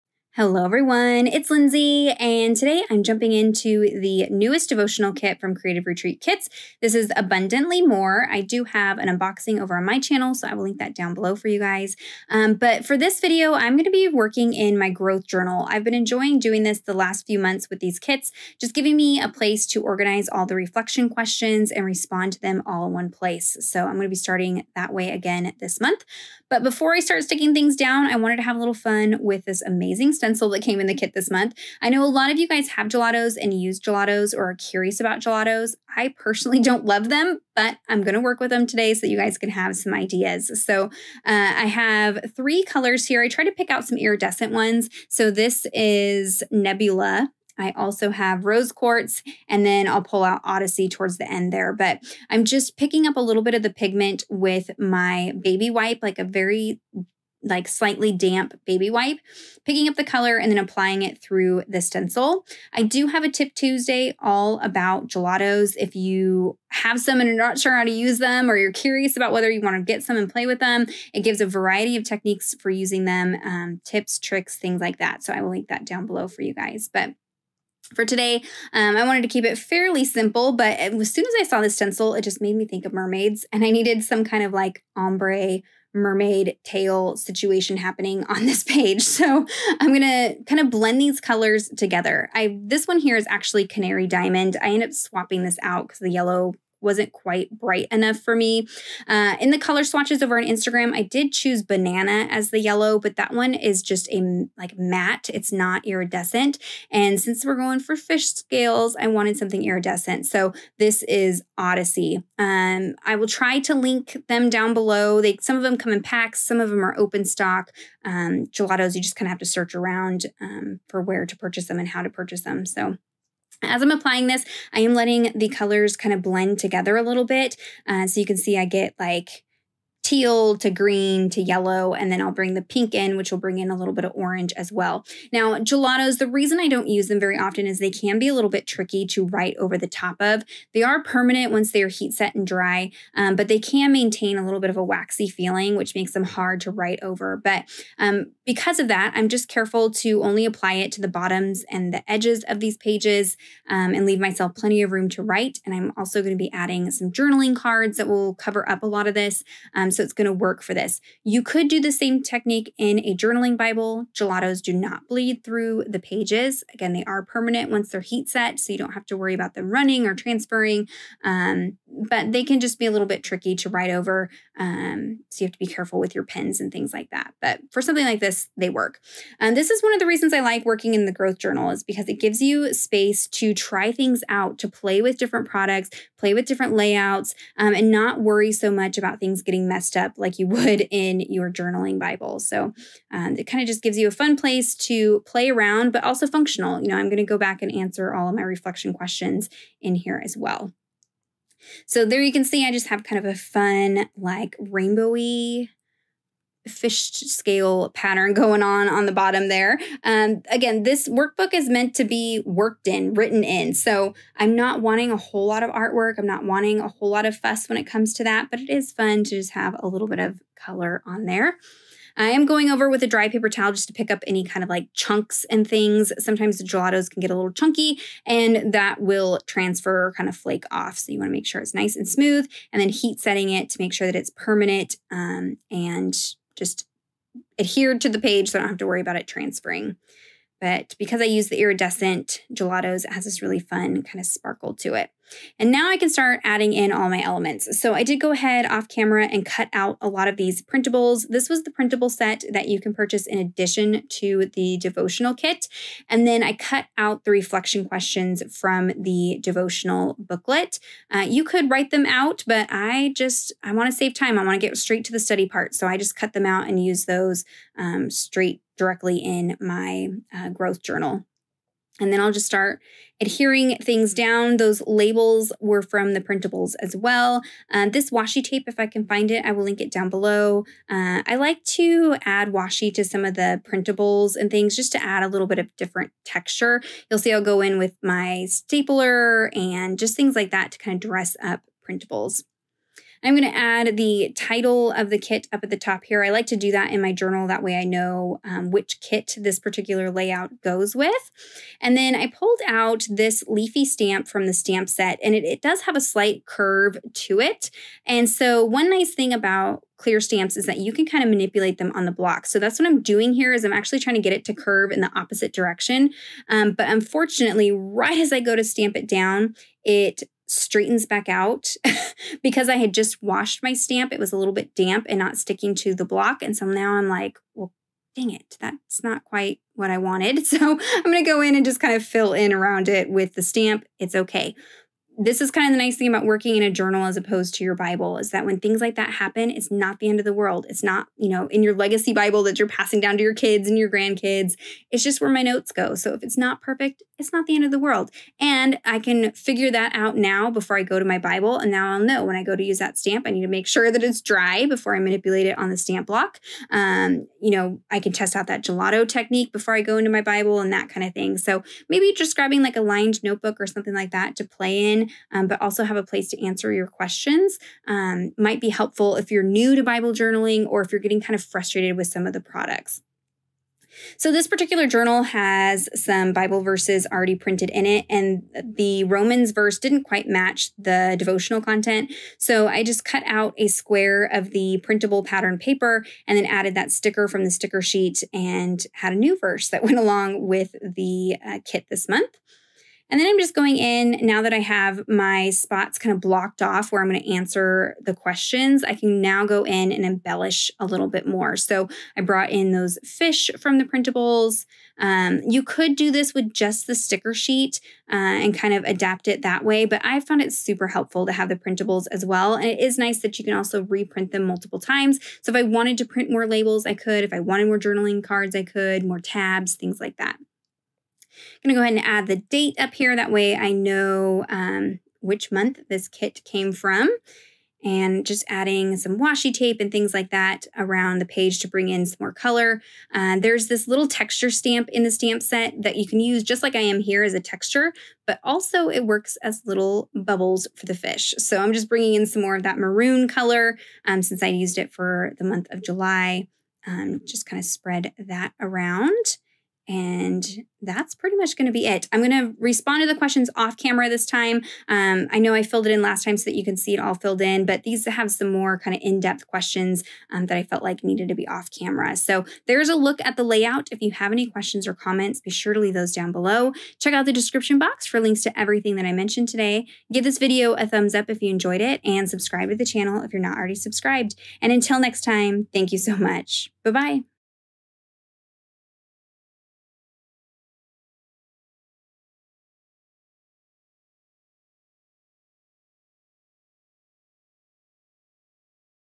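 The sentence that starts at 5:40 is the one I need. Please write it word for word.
It's not, you know, in your legacy Bible that you're passing down to your kids and your grandkids.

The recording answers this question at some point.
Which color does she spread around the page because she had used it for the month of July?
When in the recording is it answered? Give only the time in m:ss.
7:22.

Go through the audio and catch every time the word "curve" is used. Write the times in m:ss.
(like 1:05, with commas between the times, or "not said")
5:06, 5:14.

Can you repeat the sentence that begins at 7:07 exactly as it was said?
And just adding some washi tape and things like that around the page to bring in some more color.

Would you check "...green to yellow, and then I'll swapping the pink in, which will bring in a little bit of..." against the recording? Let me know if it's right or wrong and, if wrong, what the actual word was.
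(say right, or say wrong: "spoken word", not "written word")
wrong: "bring", not "swapping".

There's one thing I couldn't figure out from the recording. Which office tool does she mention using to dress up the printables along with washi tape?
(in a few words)
stapler.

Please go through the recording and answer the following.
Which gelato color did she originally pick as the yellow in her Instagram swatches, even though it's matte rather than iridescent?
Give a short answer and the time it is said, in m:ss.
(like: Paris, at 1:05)
banana, at 1:41.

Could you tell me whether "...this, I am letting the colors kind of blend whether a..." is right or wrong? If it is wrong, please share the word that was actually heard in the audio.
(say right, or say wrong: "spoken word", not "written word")
wrong: "together", not "whether".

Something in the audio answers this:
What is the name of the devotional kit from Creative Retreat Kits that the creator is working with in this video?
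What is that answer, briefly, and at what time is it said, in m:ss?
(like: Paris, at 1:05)
Abundantly More, at 0:07.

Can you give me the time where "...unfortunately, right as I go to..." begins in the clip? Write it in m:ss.
5:16.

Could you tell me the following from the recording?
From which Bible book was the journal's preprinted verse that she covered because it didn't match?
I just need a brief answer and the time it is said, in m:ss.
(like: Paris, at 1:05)
Romans, at 6:19.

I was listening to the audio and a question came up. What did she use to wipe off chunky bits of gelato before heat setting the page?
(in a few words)
a dry paper towel.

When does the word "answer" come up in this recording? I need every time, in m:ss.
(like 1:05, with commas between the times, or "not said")
3:17, 6:06, 6:37.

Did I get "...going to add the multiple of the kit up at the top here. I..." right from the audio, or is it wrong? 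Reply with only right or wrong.
wrong.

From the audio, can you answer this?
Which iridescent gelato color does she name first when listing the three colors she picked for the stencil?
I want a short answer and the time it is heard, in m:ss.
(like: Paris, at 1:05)
Nebula, at 0:46.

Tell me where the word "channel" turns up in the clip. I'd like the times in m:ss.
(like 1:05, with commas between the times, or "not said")
0:09, 7:52.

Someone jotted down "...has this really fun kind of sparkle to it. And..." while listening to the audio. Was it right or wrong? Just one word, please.
right.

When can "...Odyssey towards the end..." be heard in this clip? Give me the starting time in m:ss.
0:50.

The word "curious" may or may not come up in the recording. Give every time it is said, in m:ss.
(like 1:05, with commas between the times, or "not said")
0:34, 1:08.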